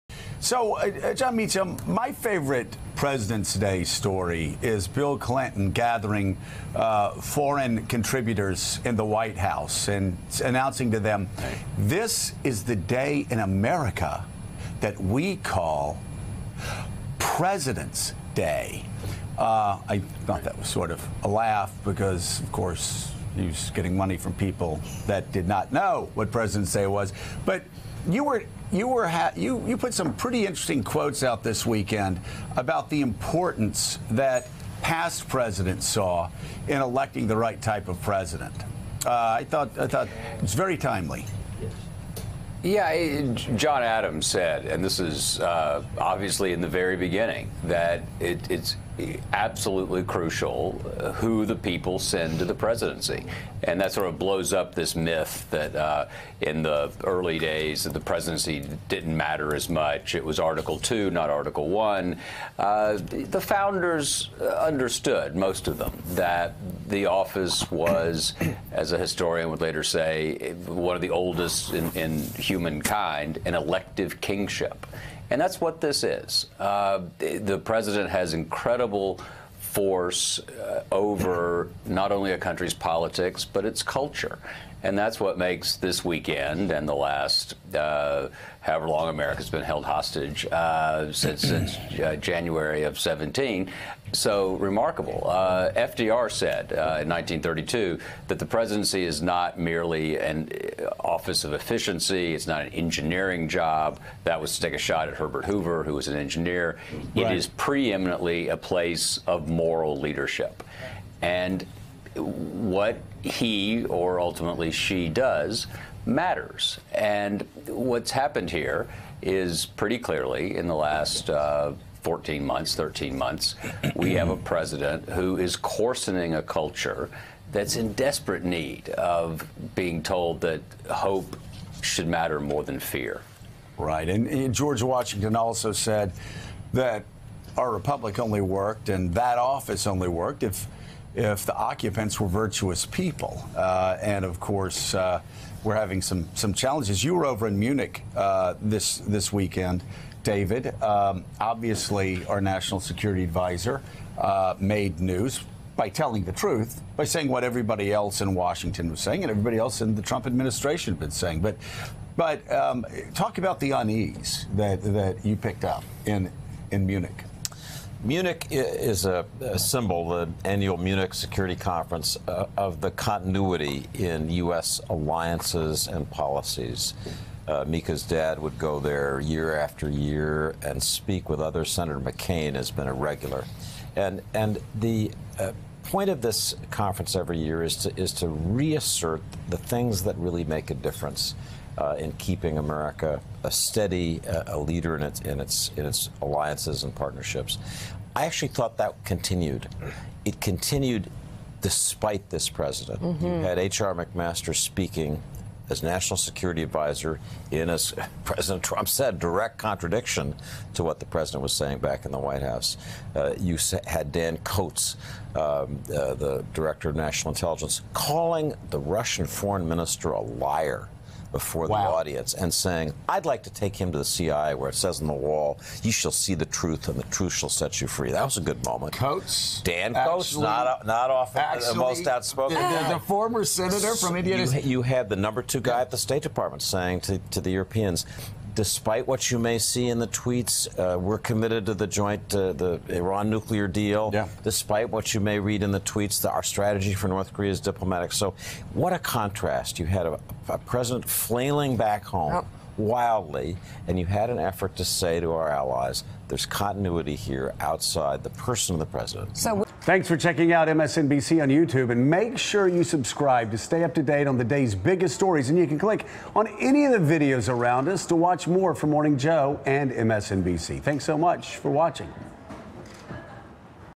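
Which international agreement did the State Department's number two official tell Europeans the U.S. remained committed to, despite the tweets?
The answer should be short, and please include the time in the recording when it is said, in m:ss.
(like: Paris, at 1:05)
Iran nuclear deal, at 4:02.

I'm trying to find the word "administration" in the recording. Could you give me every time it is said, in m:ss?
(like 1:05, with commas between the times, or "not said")
2:40.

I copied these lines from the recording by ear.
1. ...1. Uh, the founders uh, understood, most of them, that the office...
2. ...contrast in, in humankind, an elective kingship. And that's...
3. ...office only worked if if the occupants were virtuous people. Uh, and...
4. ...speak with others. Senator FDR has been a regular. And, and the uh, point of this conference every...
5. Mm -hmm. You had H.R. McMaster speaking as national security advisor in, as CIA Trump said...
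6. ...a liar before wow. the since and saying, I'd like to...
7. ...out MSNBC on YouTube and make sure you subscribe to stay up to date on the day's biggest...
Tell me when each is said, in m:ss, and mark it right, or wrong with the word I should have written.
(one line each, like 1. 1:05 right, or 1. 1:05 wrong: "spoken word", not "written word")
1. 1:01 right
2. 1:11 wrong: "oldest", not "contrast"
3. 2:19 right
4. 3:00 wrong: "McCain", not "FDR"
5. 3:23 wrong: "President", not "CIA"
6. 3:40 wrong: "audience", not "since"
7. 4:20 right.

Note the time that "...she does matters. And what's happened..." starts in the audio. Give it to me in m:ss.
1:54.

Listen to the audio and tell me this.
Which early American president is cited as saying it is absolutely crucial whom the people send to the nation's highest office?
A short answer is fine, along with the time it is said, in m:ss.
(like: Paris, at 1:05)
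John Adams, at 0:43.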